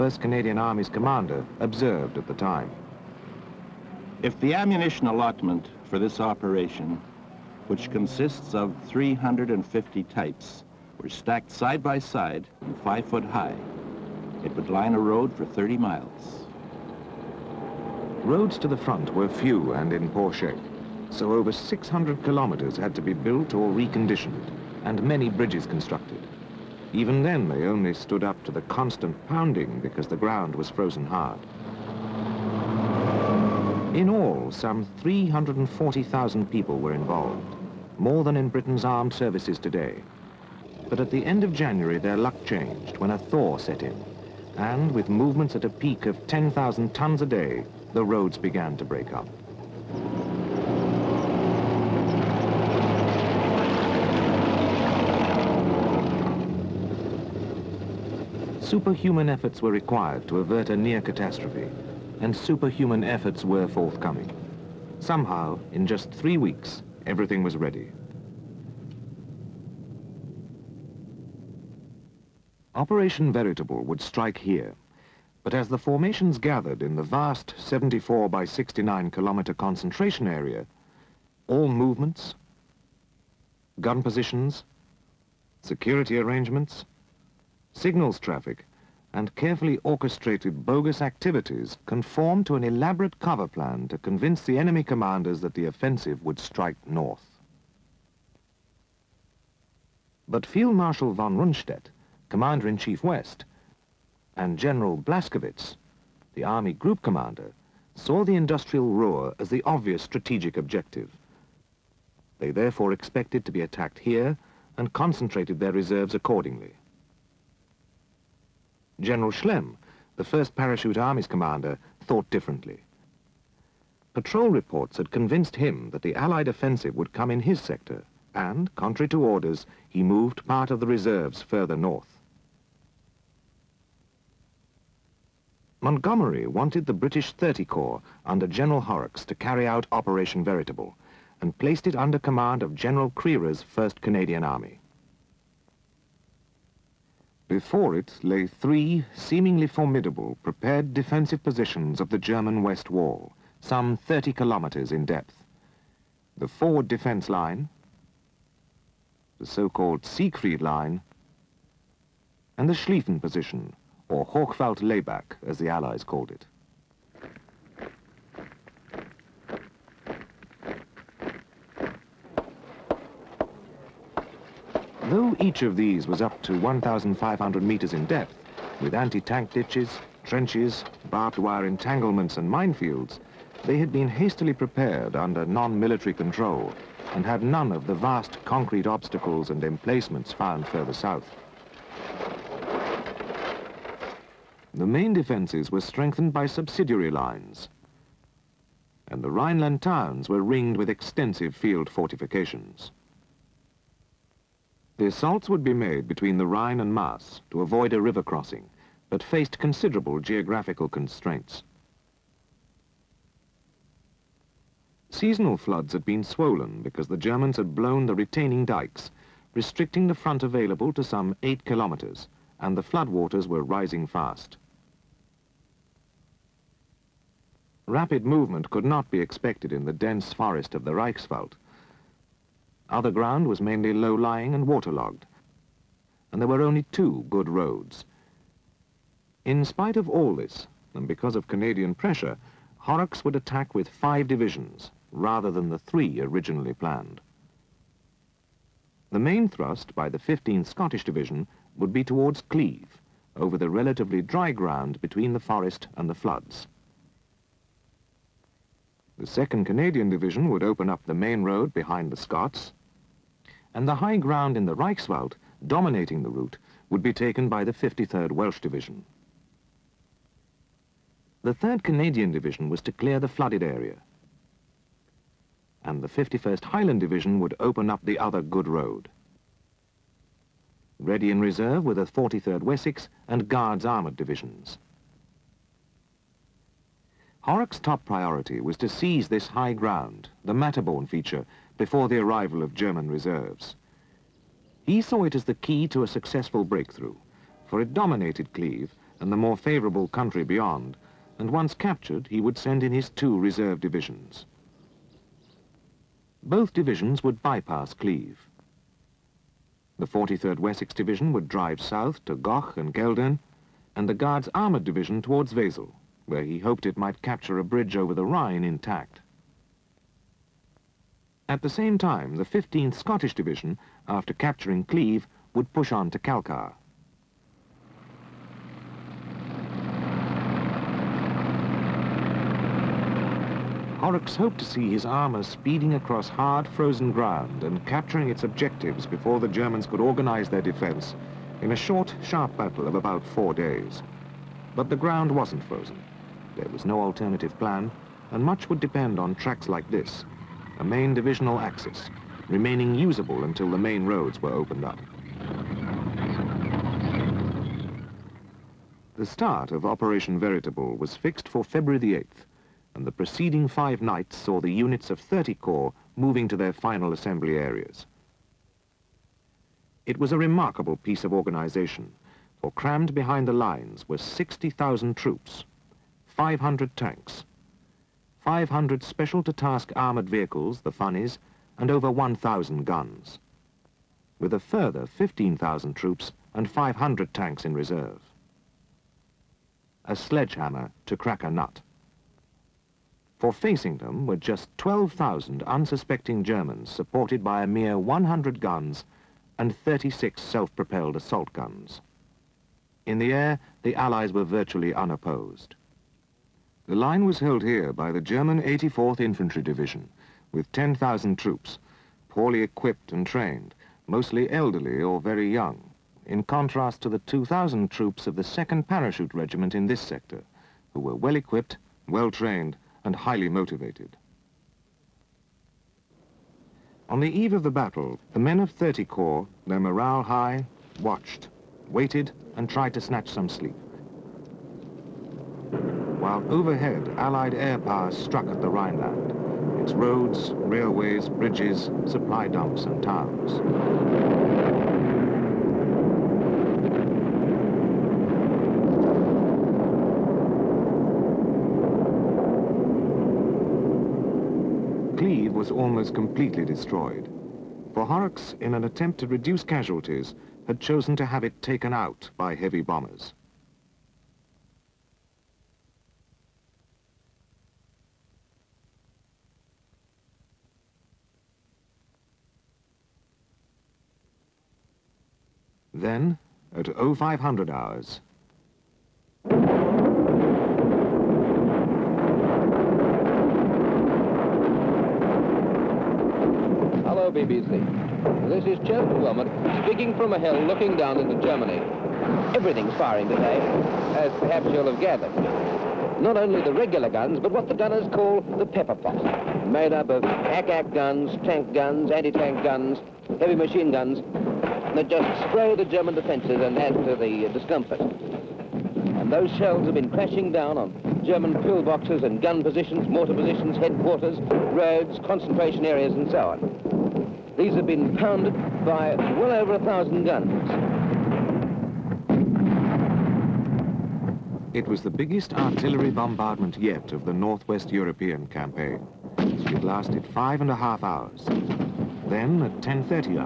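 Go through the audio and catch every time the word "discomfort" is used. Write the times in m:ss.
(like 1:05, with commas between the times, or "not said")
8:27.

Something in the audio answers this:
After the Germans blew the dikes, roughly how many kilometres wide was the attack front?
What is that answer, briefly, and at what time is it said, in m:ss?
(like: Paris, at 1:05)
8 kilometres, at 3:41.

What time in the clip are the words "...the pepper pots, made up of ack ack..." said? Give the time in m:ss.
8:18.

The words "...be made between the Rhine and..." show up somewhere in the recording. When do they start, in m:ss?
3:25.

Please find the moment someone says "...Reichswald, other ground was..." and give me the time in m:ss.
3:50.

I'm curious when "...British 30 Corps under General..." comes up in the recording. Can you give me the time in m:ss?
2:16.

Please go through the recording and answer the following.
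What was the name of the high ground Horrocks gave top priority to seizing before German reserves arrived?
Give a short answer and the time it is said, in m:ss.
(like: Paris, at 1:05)
Materborn feature, at 4:50.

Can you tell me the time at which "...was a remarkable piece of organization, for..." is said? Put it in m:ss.
6:10.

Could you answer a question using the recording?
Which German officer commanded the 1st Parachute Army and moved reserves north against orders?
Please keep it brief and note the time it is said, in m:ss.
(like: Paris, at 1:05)
General Schlemm, at 1:58.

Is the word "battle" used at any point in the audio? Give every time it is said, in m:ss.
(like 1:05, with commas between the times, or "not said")
5:42, 7:07.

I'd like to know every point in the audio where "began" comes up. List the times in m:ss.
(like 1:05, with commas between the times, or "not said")
0:48.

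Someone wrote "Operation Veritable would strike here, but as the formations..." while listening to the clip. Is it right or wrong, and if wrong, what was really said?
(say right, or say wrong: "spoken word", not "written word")
right.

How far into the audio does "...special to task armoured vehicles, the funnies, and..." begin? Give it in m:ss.
6:19.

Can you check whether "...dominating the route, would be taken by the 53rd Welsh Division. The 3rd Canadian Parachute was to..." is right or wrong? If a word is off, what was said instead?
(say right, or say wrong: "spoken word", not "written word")
wrong: "Division", not "Parachute".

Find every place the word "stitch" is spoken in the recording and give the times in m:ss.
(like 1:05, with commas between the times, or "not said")
not said.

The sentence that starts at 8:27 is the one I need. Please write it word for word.
And those shells have been crashing down on German pillboxes and gun positions, mortar positions, headquarters, roads, concentration areas and so on.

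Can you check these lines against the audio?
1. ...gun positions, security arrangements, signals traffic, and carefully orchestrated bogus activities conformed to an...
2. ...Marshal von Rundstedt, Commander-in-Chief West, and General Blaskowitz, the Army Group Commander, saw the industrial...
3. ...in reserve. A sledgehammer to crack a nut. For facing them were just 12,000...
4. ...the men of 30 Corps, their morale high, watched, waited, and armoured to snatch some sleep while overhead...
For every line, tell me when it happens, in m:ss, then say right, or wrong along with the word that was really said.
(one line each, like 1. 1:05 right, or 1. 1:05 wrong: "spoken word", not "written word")
1. 1:23 right
2. 1:40 right
3. 6:27 right
4. 7:08 wrong: "tried", not "armoured".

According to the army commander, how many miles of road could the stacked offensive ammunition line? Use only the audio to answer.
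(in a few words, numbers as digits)
30.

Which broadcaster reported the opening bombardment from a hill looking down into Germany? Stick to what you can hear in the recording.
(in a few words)
Chester Wilmot.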